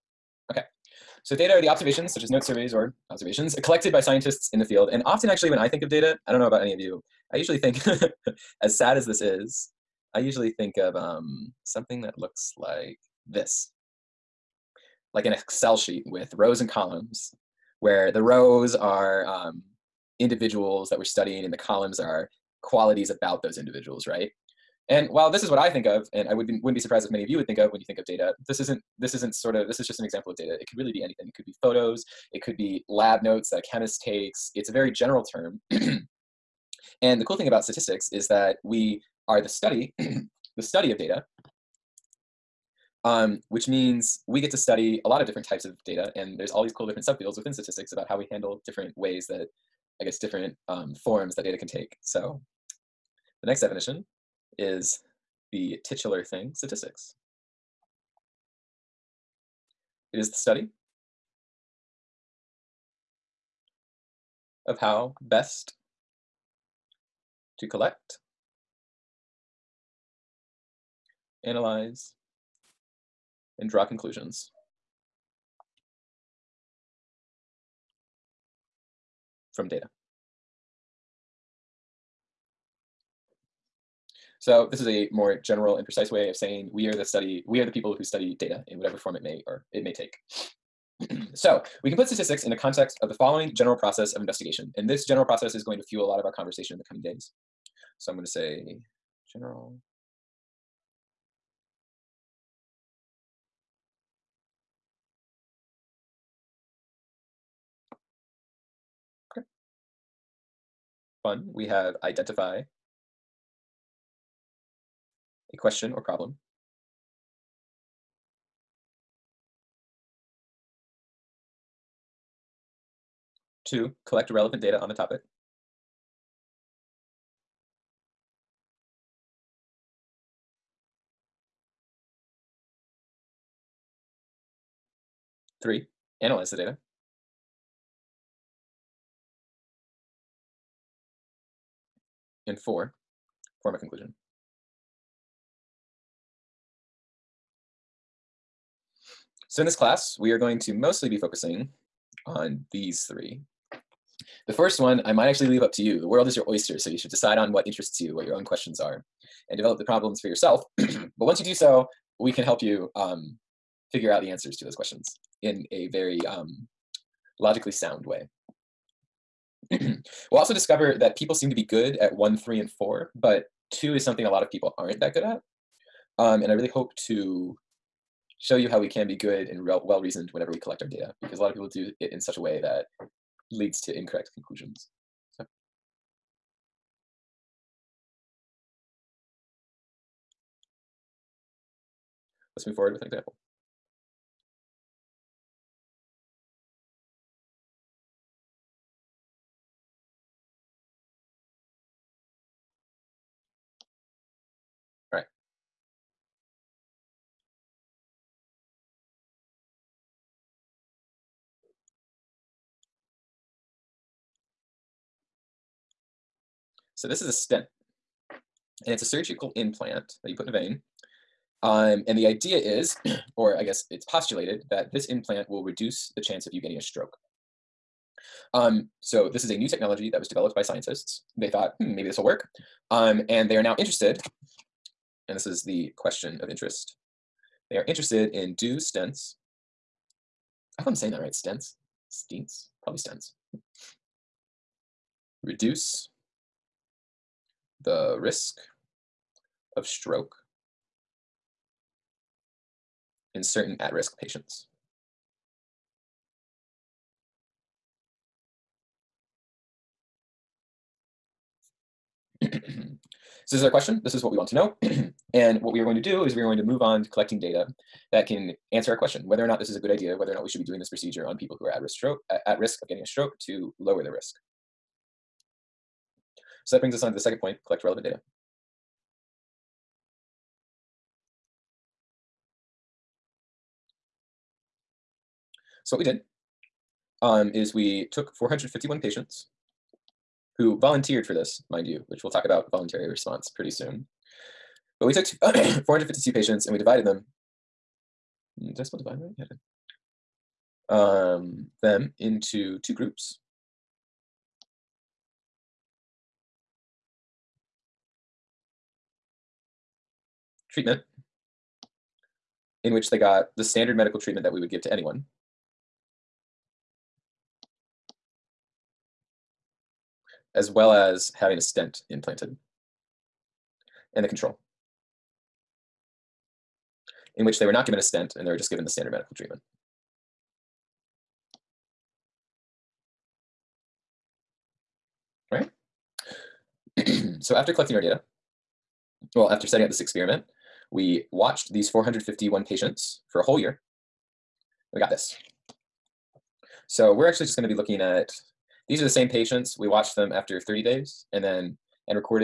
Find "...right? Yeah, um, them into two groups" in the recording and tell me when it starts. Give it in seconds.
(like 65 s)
299 s.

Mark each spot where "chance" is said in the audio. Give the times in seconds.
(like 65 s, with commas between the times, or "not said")
226 s.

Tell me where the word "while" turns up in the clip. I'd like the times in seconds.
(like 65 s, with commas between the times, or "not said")
25 s.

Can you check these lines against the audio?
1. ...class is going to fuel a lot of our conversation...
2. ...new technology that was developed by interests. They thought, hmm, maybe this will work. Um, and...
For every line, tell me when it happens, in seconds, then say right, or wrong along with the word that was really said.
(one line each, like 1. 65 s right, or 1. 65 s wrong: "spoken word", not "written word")
1. 95 s wrong: "process", not "class"
2. 229 s wrong: "scientists", not "interests".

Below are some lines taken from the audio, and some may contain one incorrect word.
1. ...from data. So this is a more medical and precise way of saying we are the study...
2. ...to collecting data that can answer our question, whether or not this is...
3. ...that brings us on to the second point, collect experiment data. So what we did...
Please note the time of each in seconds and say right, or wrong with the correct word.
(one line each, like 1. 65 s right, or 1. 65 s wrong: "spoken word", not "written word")
1. 79 s wrong: "general", not "medical"
2. 267 s right
3. 276 s wrong: "relevant", not "experiment".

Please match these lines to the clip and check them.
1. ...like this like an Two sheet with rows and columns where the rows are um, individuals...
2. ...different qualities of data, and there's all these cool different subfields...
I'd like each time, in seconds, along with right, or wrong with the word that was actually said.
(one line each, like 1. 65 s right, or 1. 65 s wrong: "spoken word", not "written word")
1. 12 s wrong: "Excel", not "Two"
2. 45 s wrong: "types", not "qualities".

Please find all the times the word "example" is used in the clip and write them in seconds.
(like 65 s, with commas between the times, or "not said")
30 s, 193 s.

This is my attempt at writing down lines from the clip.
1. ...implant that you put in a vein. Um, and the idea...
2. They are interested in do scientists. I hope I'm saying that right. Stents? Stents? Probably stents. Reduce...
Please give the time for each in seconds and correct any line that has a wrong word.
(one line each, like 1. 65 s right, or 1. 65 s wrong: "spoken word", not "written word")
1. 219 s right
2. 237 s wrong: "stents", not "scientists".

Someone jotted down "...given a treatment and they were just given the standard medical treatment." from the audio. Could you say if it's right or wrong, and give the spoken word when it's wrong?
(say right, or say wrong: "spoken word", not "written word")
wrong: "stent", not "treatment".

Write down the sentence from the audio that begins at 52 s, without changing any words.
So the next definition is the titular thing, statistics.